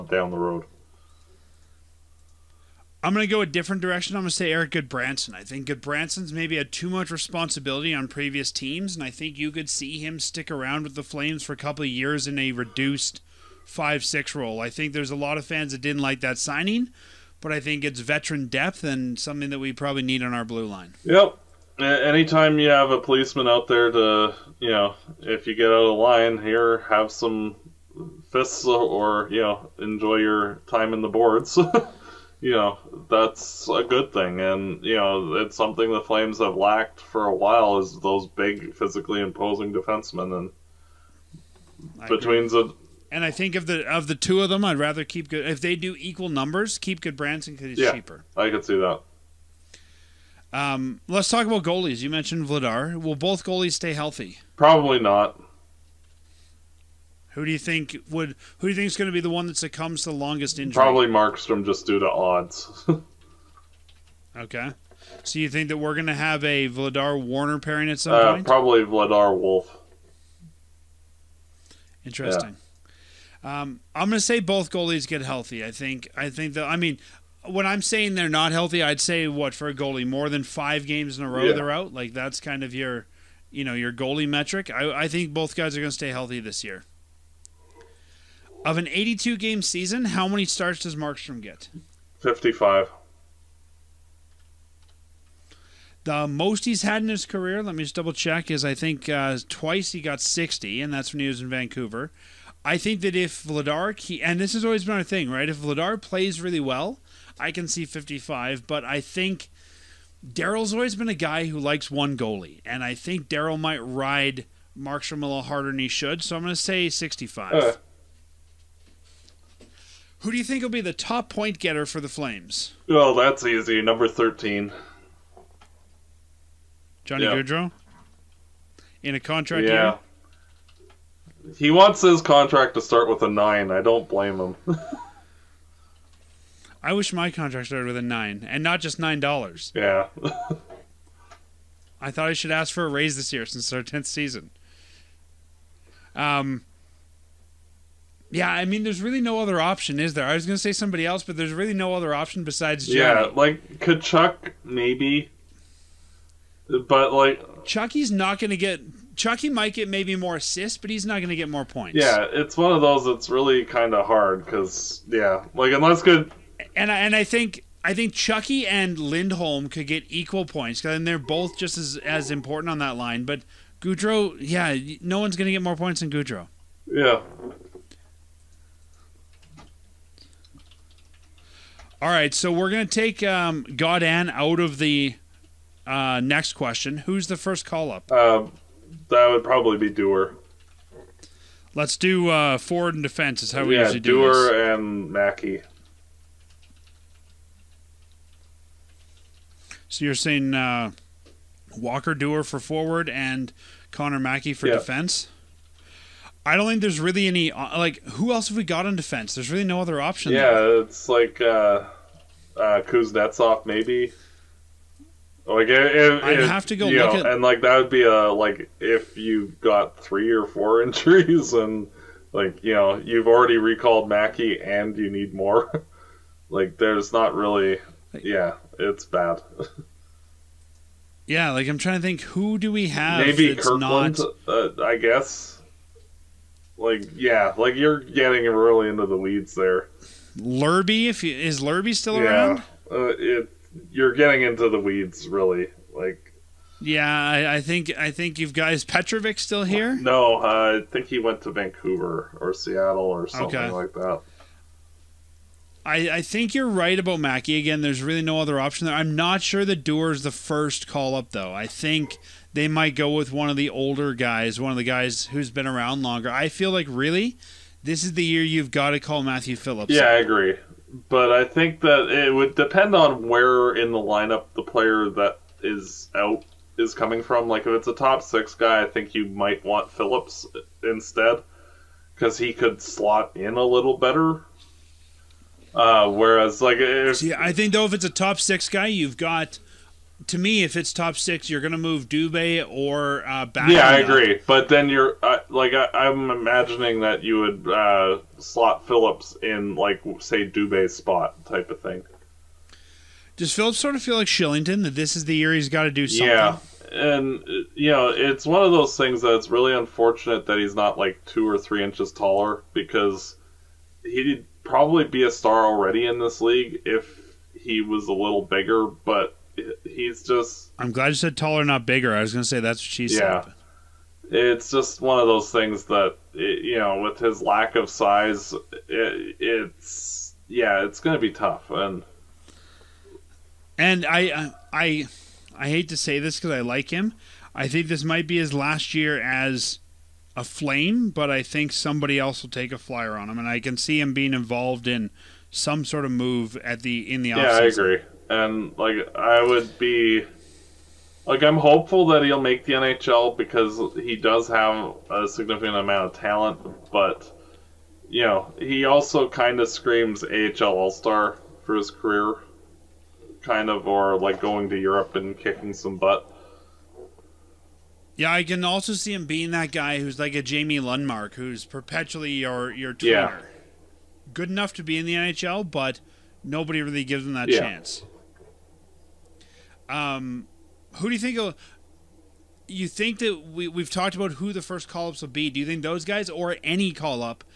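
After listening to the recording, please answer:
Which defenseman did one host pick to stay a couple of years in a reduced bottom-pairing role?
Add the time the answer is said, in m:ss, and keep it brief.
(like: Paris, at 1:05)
Erik Gudbranson, at 0:04.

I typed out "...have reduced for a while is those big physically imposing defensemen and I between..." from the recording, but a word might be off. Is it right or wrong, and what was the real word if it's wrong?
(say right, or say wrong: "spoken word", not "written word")
wrong: "lacked", not "reduced".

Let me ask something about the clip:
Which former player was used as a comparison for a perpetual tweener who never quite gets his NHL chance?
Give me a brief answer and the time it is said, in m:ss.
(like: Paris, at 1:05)
Jamie Lundmark, at 6:10.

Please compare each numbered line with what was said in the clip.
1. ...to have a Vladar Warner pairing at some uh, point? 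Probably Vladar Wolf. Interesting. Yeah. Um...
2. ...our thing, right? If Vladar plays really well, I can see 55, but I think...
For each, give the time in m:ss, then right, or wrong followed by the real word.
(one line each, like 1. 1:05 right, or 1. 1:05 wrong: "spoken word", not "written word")
1. 1:06 right
2. 1:44 right.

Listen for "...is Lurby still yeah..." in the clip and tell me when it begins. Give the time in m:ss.
4:01.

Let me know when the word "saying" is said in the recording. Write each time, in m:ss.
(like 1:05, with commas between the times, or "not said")
1:17, 3:20.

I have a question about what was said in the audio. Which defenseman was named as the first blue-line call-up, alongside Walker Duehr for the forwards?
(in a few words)
Connor Mackey.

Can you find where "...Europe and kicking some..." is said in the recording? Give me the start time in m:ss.
6:04.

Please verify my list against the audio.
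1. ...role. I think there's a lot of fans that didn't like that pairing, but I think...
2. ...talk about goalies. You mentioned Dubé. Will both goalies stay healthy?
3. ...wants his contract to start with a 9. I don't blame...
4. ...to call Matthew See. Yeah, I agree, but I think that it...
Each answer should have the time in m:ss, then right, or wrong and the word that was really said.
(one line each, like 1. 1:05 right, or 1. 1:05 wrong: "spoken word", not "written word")
1. 0:14 wrong: "signing", not "pairing"
2. 0:51 wrong: "Vladar", not "Dubé"
3. 2:11 right
4. 4:28 wrong: "Phillips", not "See".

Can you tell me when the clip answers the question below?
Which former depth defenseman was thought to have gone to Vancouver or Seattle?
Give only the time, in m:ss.
4:08.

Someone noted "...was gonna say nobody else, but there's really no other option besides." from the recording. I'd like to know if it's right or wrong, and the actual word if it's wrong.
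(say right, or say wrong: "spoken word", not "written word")
wrong: "somebody", not "nobody".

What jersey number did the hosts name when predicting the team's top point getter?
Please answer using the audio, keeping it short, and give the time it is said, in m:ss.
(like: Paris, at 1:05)
13, at 2:03.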